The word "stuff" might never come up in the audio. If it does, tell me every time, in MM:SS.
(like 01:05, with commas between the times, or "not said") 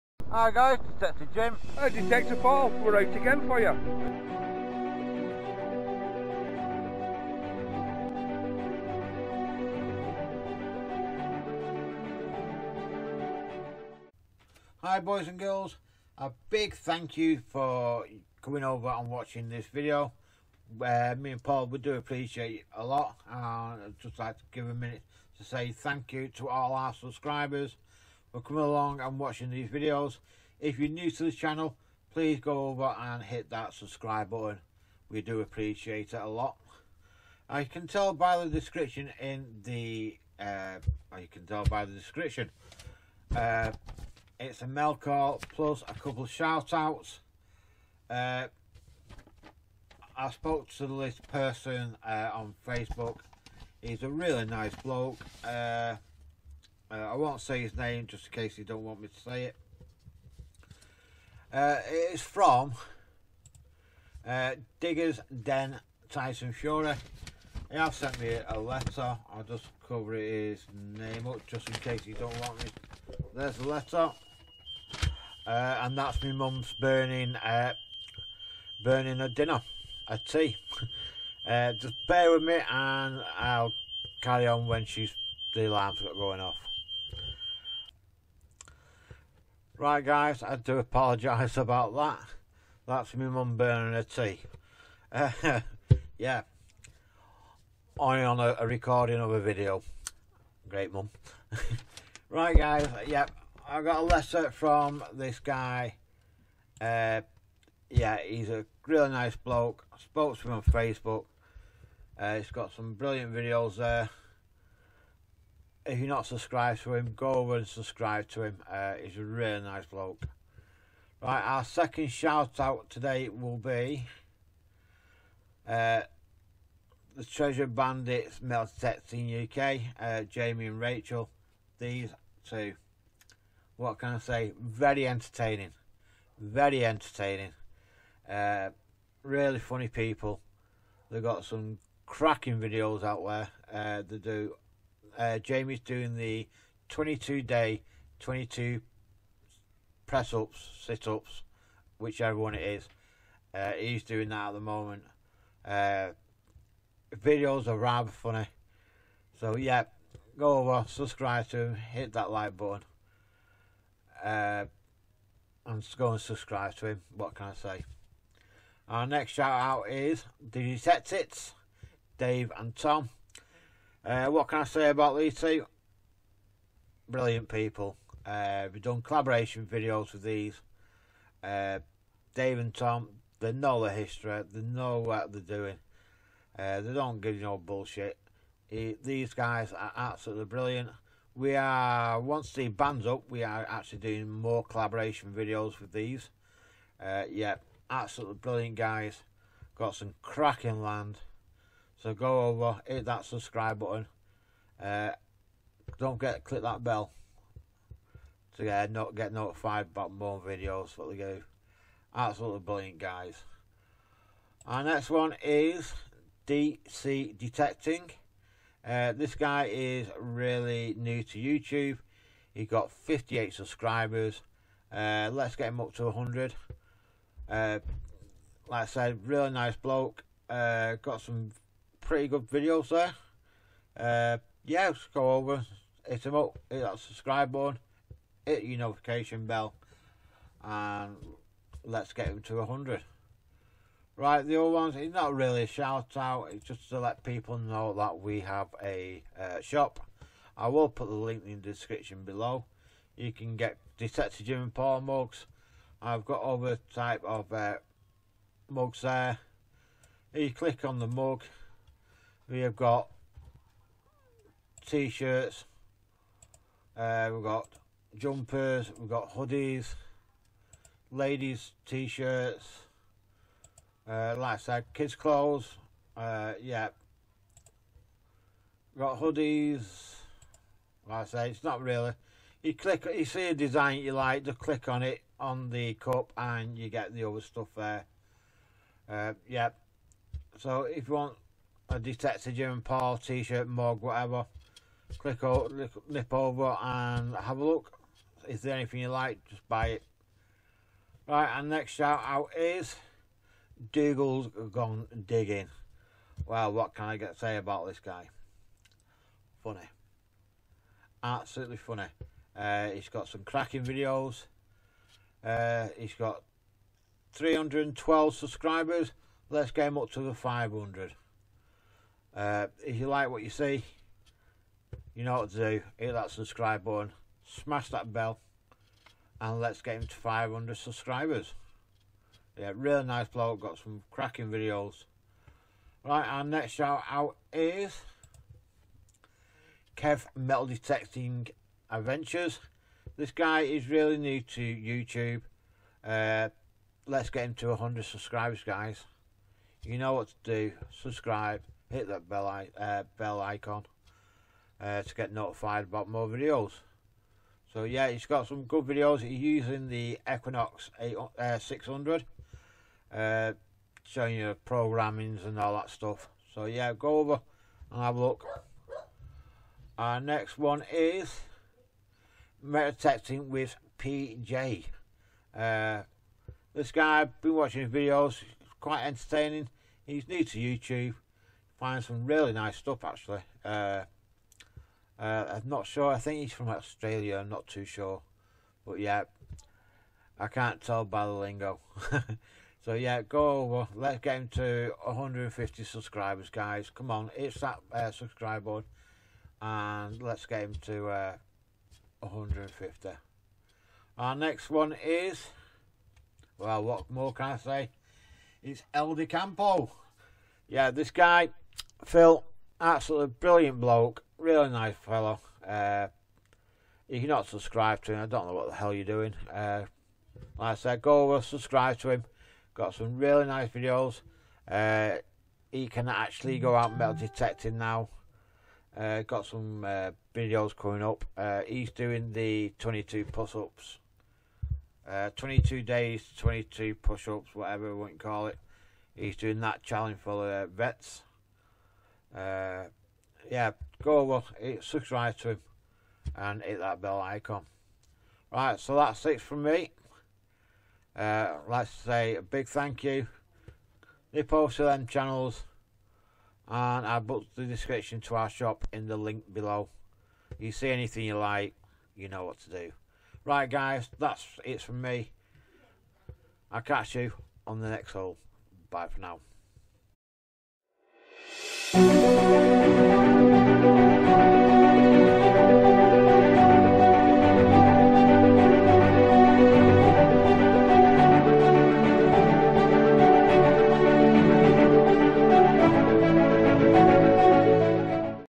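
04:47, 06:05, 06:22.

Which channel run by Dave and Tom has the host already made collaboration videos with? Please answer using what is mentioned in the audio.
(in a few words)
Detectits.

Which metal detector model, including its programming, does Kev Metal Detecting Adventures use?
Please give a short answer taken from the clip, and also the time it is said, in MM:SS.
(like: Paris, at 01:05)
Equinox 600, at 06:00.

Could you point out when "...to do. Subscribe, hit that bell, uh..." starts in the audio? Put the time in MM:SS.
05:50.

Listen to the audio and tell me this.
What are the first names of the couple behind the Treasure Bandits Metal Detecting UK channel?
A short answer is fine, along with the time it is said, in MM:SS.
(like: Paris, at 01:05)
Jamie and Rachel, at 02:10.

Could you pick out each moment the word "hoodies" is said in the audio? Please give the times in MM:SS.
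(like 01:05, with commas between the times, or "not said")
04:29, 04:39.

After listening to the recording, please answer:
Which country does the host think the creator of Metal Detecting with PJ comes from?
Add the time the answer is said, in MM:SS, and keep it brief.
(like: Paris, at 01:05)
Australia, at 06:26.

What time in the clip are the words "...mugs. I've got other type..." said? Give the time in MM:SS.
04:14.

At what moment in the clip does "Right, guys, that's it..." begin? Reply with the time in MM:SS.
07:43.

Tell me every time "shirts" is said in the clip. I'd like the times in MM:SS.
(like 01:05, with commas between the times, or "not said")
04:24, 04:31, 04:53.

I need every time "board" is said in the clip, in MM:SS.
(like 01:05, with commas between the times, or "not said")
06:38.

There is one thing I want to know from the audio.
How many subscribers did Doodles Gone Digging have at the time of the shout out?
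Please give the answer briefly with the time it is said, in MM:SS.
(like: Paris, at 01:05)
312, at 05:17.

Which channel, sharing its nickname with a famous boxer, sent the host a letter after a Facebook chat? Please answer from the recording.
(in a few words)
Diggers Den Tyson Fury.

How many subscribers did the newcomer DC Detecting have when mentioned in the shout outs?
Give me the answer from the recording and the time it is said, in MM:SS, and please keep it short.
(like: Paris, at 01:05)
58, at 03:42.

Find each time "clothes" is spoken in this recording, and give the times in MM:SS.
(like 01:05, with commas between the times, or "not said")
04:35.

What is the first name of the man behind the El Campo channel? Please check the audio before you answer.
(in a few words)
Phil.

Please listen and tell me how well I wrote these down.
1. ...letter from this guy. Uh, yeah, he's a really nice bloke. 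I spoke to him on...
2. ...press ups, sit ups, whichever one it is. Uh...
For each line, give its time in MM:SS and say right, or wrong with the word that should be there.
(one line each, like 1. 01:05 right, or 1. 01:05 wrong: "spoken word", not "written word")
1. 01:44 right
2. 02:30 right.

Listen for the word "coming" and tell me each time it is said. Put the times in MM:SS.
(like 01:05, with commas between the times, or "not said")
00:18, 00:28, 07:10.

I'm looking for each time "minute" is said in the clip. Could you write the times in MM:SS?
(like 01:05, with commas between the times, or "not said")
00:24.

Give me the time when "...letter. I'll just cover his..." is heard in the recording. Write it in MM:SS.
01:08.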